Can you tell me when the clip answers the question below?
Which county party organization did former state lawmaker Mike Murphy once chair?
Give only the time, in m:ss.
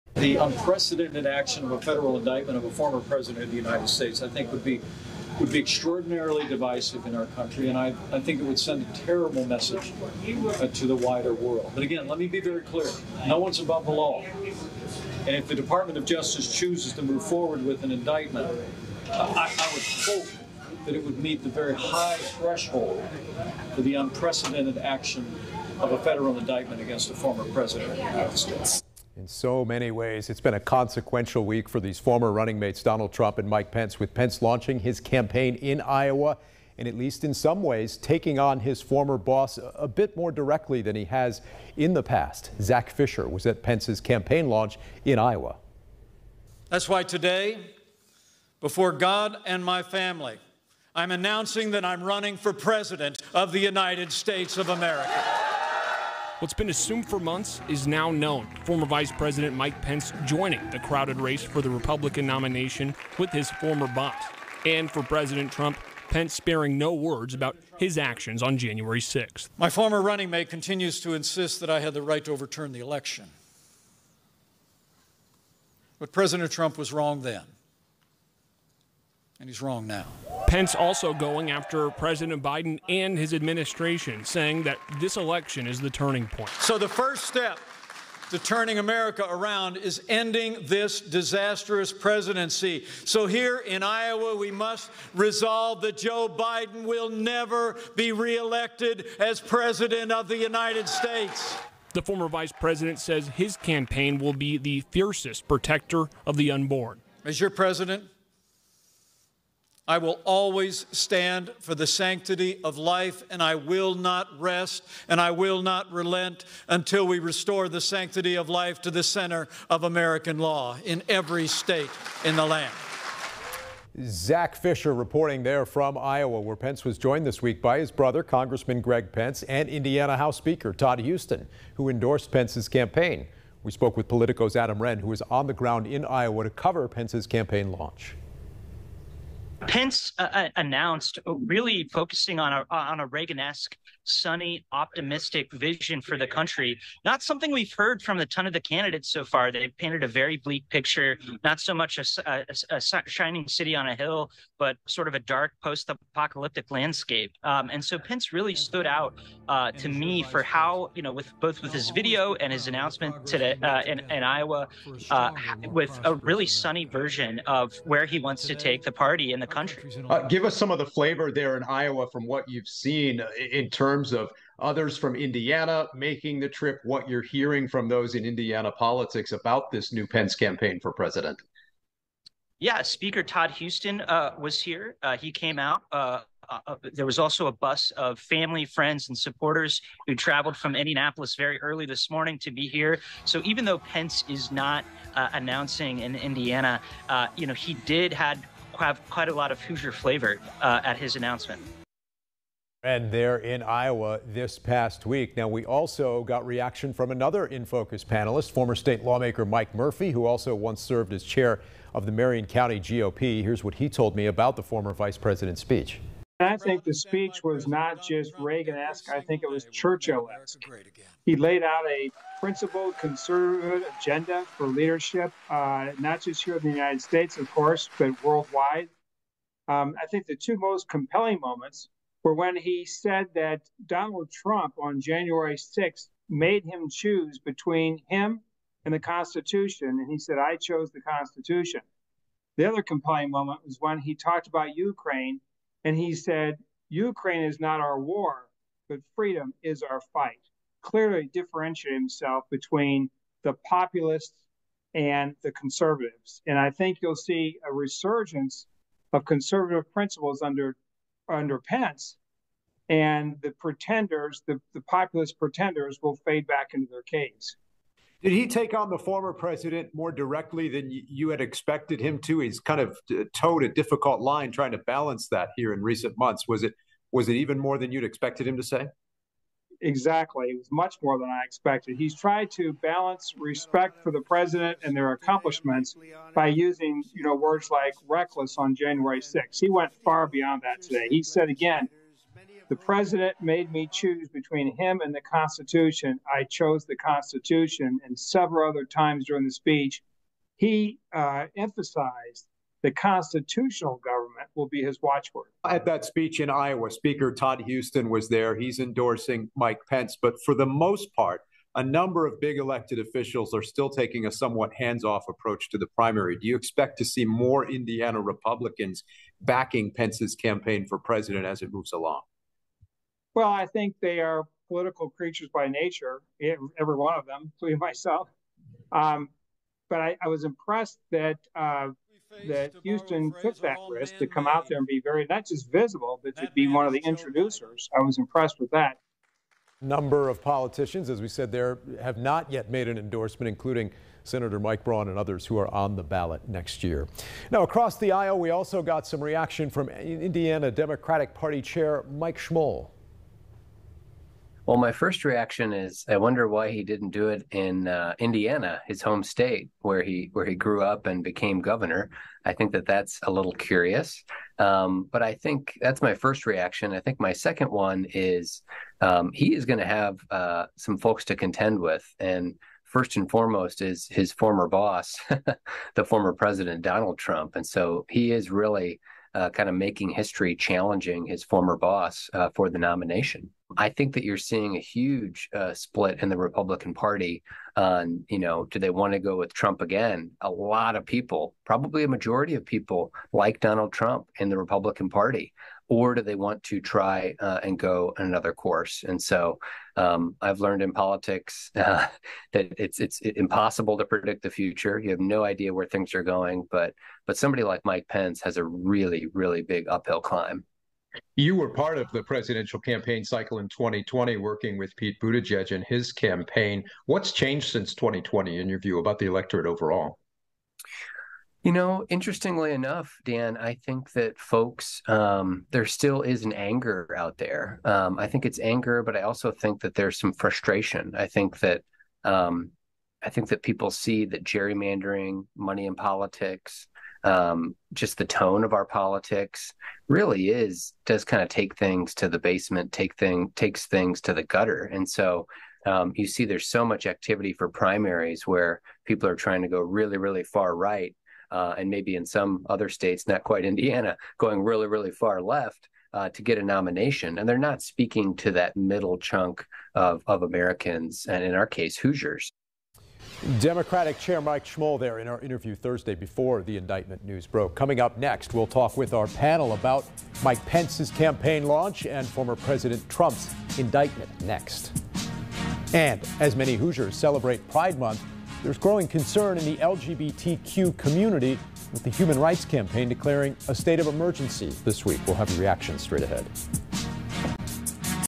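3:32.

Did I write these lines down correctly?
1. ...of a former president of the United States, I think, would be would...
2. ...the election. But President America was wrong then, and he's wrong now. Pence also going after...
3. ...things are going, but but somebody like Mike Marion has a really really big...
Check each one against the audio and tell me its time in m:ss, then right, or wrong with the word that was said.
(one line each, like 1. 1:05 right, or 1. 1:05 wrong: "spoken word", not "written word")
1. 0:02 right
2. 1:12 wrong: "Trump", not "America"
3. 6:45 wrong: "Pence", not "Marion".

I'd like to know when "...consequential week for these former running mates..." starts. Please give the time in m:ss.
0:30.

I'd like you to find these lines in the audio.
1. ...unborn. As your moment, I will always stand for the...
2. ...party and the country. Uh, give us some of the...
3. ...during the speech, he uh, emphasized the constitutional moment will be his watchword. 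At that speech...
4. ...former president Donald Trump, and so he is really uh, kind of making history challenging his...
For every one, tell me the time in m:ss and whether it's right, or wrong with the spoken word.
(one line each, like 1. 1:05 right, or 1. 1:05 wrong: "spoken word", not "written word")
1. 1:46 wrong: "president", not "moment"
2. 2:48 right
3. 4:59 wrong: "government", not "moment"
4. 6:16 right.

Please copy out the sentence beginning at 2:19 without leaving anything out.
Pence uh, uh announced uh, really focusing on a on a Reagan-esque sunny, optimistic vision for the country.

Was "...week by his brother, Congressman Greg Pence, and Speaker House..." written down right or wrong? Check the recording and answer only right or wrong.
wrong.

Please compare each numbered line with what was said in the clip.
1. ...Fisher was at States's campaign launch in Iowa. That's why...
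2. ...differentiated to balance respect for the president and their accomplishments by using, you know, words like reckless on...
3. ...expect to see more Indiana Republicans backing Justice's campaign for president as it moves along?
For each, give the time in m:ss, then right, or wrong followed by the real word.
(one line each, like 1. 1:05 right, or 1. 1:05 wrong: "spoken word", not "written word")
1. 0:42 wrong: "Pence", not "States"
2. 4:42 wrong: "tried", not "differentiated"
3. 5:16 wrong: "Pence", not "Justice".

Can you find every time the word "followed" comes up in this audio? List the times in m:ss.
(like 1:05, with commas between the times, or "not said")
not said.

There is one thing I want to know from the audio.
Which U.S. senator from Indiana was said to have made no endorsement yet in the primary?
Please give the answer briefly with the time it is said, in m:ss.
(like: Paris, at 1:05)
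Mike Braun, at 5:44.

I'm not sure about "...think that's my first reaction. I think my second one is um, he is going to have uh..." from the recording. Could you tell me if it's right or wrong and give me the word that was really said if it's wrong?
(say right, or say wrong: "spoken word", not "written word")
right.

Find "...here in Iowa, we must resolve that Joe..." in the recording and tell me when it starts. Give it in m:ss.
1:33.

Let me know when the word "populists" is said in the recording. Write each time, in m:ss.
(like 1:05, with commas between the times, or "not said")
4:13, 4:24.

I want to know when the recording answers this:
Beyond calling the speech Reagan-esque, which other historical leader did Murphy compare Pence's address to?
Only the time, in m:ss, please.
3:39.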